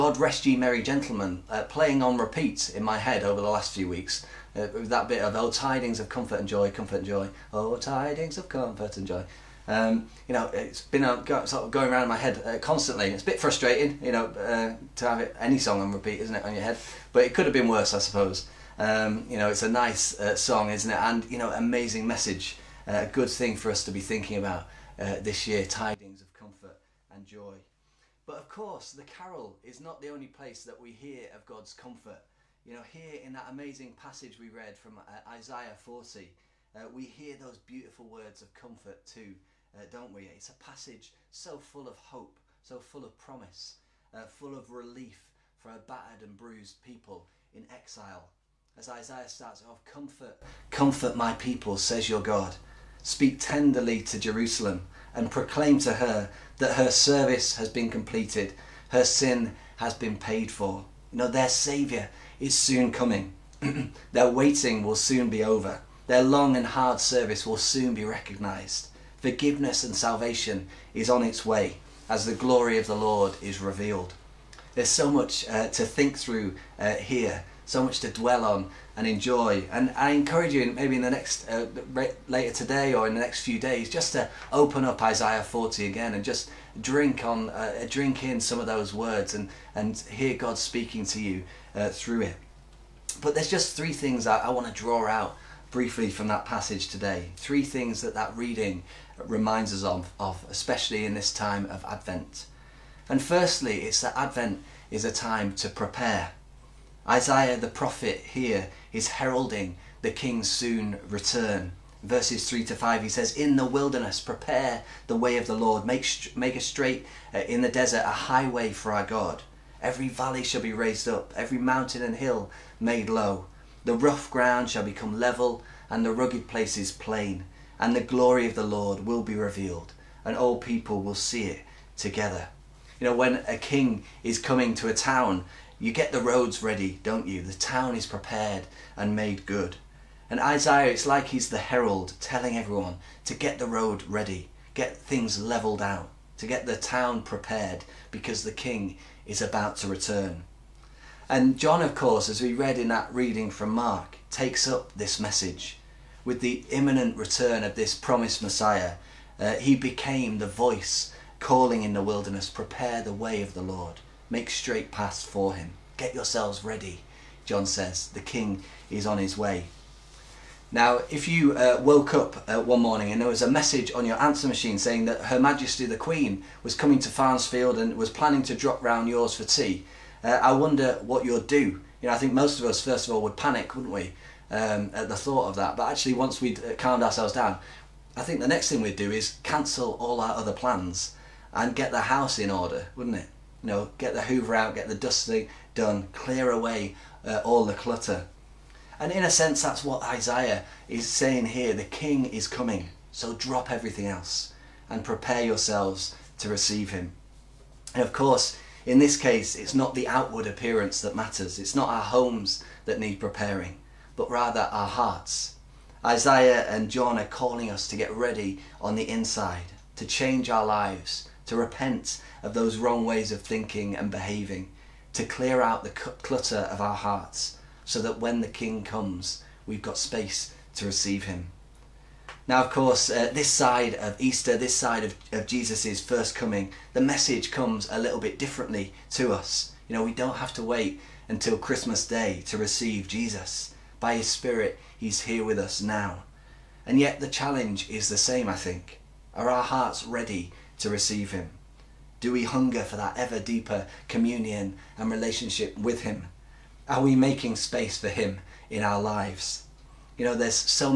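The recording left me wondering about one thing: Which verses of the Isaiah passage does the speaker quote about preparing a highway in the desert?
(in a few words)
3 to 5.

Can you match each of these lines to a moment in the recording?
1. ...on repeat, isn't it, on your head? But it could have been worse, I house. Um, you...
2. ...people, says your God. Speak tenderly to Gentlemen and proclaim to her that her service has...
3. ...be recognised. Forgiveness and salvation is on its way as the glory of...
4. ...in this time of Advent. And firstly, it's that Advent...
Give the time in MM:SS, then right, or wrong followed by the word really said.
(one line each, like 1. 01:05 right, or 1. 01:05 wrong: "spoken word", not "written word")
1. 00:15 wrong: "suppose", not "house"
2. 00:51 wrong: "Jerusalem", not "Gentlemen"
3. 01:07 right
4. 01:41 right.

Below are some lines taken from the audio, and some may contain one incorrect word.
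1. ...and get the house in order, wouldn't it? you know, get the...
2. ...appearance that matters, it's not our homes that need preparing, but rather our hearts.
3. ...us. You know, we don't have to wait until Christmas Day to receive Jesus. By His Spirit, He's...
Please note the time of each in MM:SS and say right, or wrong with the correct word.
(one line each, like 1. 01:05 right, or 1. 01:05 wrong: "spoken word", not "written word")
1. 03:11 right
2. 03:30 right
3. 03:59 right.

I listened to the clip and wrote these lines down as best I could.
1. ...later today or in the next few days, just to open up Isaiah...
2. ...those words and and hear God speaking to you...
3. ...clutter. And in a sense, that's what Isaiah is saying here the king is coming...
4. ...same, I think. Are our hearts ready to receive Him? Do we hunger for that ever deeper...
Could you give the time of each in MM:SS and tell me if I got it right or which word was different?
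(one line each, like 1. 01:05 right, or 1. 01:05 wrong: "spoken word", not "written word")
1. 01:22 right
2. 01:28 right
3. 03:17 right
4. 04:08 right.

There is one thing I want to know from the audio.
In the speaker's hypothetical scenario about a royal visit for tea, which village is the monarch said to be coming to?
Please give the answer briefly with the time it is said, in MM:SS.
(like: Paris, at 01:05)
Farnsfield, at 02:57.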